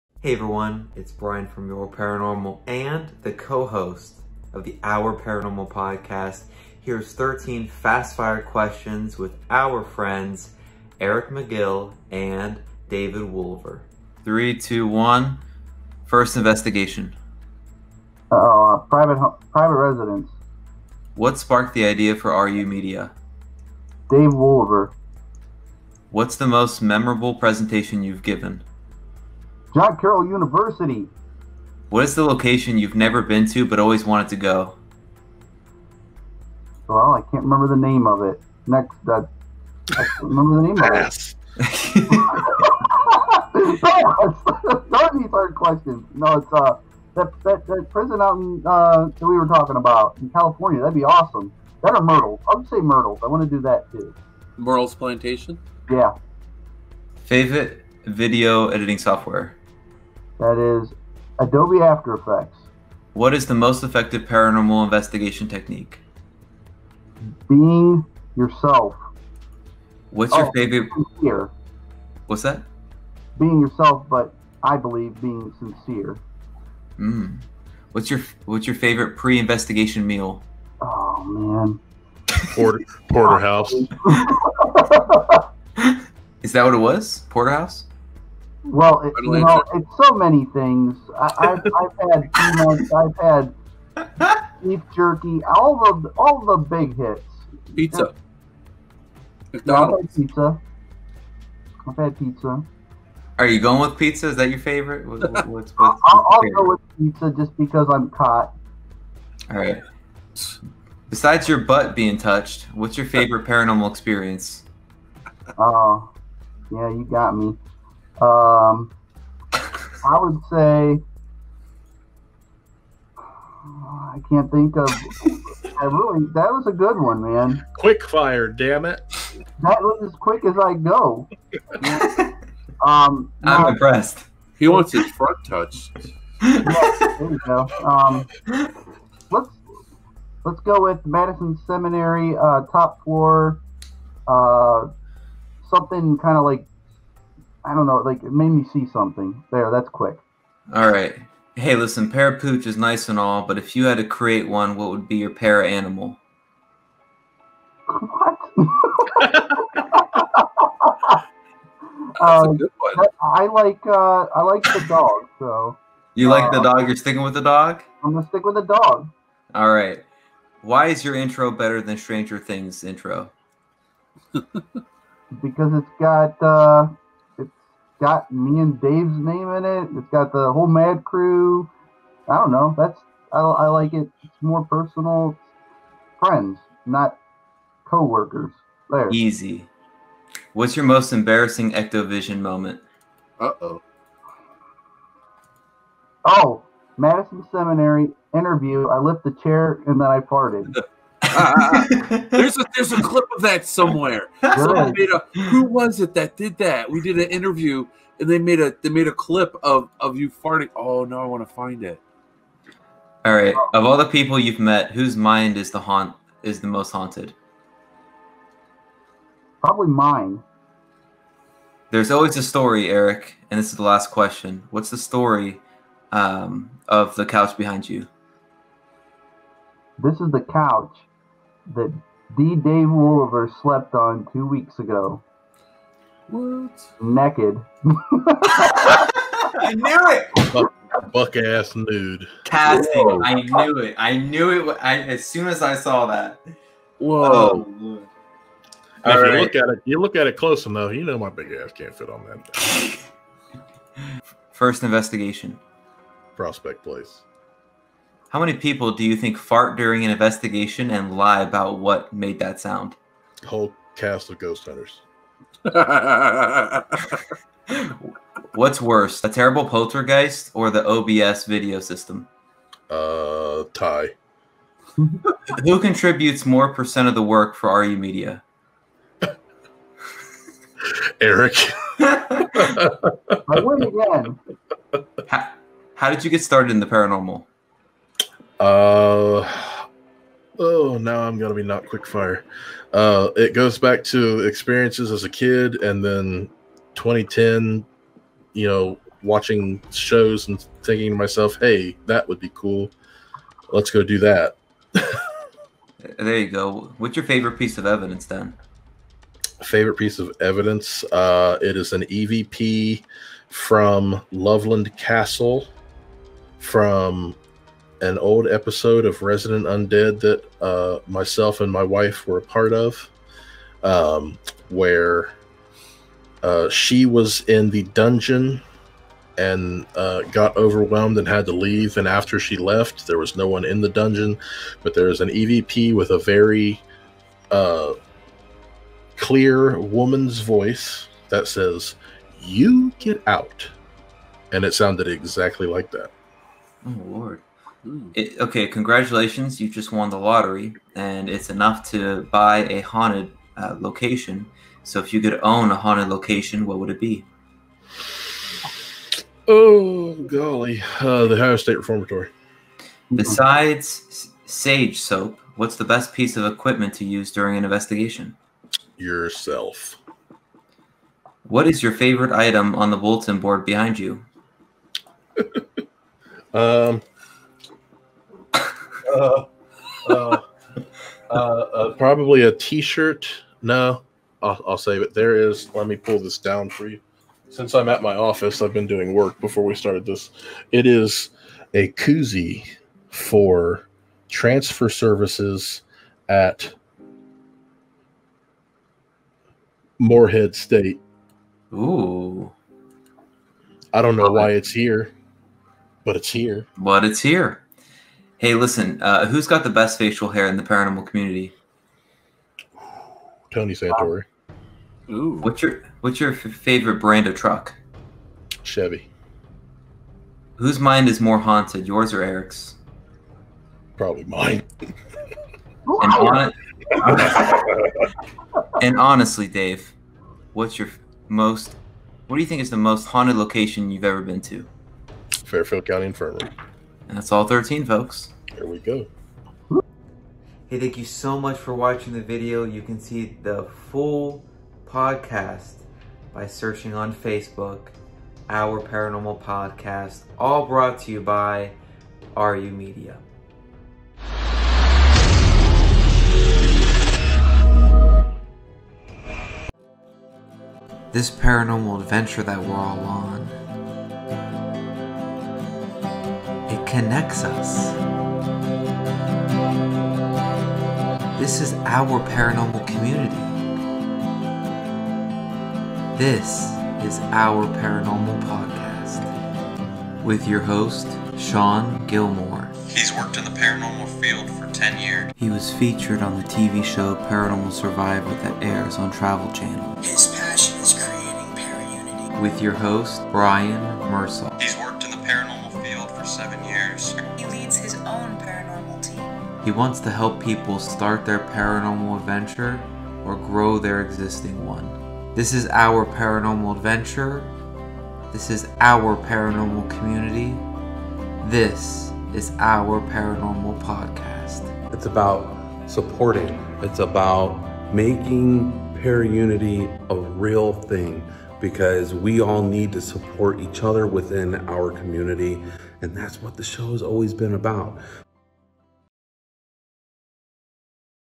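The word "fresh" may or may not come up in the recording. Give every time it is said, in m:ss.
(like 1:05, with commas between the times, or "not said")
not said.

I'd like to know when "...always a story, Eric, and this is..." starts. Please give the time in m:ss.
3:42.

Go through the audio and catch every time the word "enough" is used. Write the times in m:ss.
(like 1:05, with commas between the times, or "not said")
4:10, 5:51.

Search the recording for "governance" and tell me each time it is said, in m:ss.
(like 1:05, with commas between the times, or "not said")
not said.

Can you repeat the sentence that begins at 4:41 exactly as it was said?
I wouldn't How, how did you get started in the paranormal?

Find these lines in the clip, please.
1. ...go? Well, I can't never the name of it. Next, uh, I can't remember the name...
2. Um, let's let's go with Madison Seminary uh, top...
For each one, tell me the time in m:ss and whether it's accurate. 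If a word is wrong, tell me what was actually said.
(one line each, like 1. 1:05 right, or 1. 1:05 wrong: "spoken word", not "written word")
1. 0:34 wrong: "remember", not "never"
2. 2:17 right.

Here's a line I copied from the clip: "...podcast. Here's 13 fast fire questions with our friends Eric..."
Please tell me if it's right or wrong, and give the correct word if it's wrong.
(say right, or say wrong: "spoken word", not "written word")
right.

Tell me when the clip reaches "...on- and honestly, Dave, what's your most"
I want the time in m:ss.
7:06.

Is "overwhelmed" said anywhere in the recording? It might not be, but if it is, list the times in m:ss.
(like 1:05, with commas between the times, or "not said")
5:30.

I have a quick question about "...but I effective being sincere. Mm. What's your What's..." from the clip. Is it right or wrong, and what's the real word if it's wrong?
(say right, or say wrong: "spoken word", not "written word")
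wrong: "believe", not "effective".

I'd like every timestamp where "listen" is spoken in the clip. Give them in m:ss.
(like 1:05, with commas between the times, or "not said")
2:31, 6:48.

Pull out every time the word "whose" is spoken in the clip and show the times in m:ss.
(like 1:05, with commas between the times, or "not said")
3:34, 7:00.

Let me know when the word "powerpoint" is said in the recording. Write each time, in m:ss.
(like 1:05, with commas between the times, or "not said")
not said.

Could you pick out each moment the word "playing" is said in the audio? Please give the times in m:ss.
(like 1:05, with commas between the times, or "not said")
not said.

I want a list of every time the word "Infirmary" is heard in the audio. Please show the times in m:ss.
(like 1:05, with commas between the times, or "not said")
7:16.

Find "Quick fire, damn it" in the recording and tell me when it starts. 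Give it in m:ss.
2:07.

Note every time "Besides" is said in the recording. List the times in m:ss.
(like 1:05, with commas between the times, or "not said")
1:51, 6:03.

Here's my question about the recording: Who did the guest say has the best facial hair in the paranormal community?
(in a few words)
Tony Santori.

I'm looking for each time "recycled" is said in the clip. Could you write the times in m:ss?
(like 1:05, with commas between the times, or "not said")
not said.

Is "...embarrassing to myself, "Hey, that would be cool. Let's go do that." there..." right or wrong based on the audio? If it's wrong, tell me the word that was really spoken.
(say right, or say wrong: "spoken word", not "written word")
wrong: "thinking", not "embarrassing".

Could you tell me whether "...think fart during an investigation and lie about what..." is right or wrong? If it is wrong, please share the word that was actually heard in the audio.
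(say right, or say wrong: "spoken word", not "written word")
right.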